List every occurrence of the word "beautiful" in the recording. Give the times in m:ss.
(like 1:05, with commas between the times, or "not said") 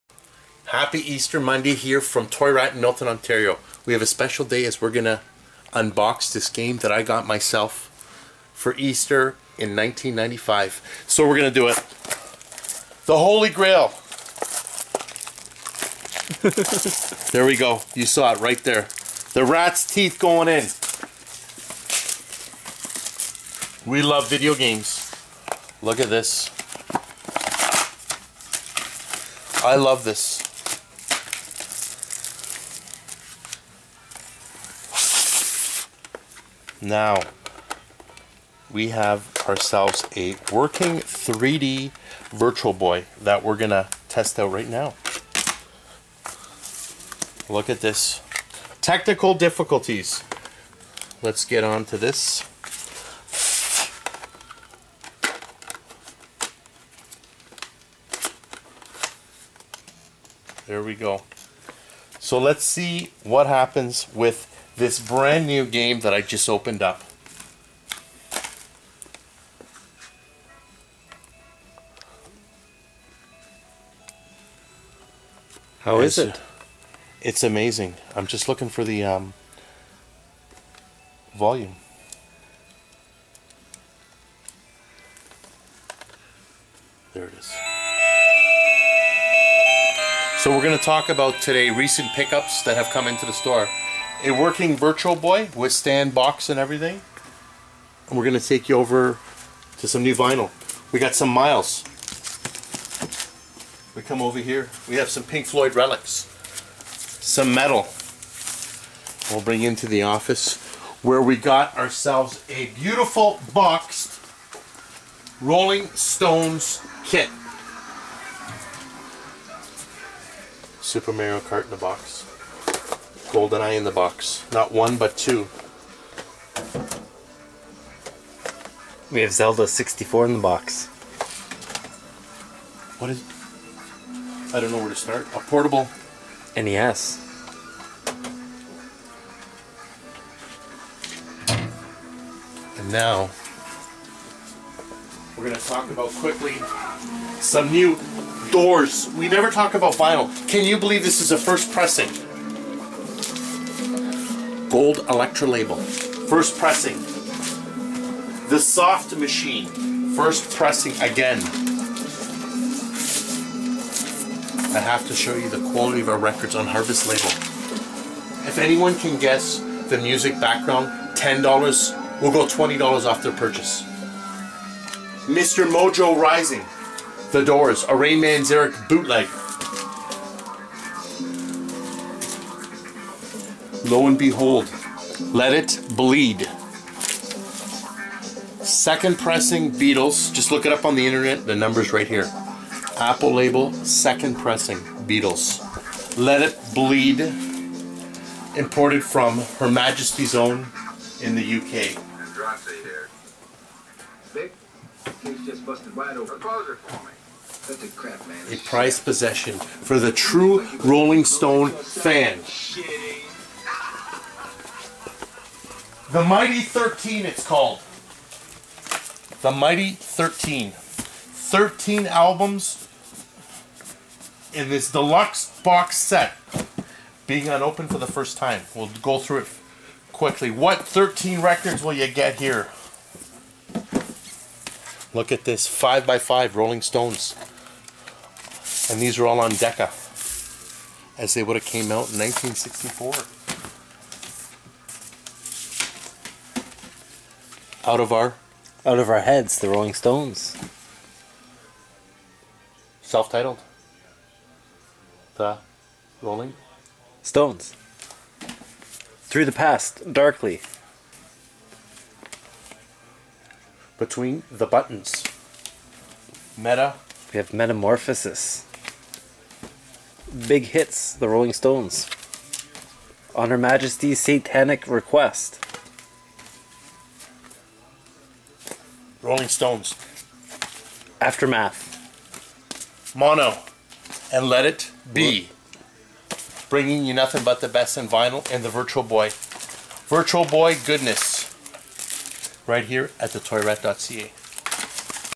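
1:52.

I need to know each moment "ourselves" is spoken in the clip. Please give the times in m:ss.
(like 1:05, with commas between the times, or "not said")
0:39, 1:51.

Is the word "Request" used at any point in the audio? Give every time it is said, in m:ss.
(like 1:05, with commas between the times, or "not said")
4:34.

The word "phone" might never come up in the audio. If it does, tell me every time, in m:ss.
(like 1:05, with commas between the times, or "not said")
not said.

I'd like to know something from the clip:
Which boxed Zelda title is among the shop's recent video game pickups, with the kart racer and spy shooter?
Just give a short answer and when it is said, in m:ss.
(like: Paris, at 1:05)
Zelda 64, at 2:09.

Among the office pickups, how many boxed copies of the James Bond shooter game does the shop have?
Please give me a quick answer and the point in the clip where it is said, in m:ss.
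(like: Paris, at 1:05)
2, at 2:05.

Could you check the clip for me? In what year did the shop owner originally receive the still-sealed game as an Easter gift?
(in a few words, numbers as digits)
1995.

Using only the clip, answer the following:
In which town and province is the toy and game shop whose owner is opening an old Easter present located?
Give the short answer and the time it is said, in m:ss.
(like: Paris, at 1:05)
Milton, Ontario, at 0:02.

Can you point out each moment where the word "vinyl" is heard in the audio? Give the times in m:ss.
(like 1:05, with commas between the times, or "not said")
1:40, 2:29, 4:48.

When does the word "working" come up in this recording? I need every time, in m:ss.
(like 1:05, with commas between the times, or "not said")
0:40, 1:34.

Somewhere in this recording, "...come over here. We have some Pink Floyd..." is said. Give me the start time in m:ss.
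1:44.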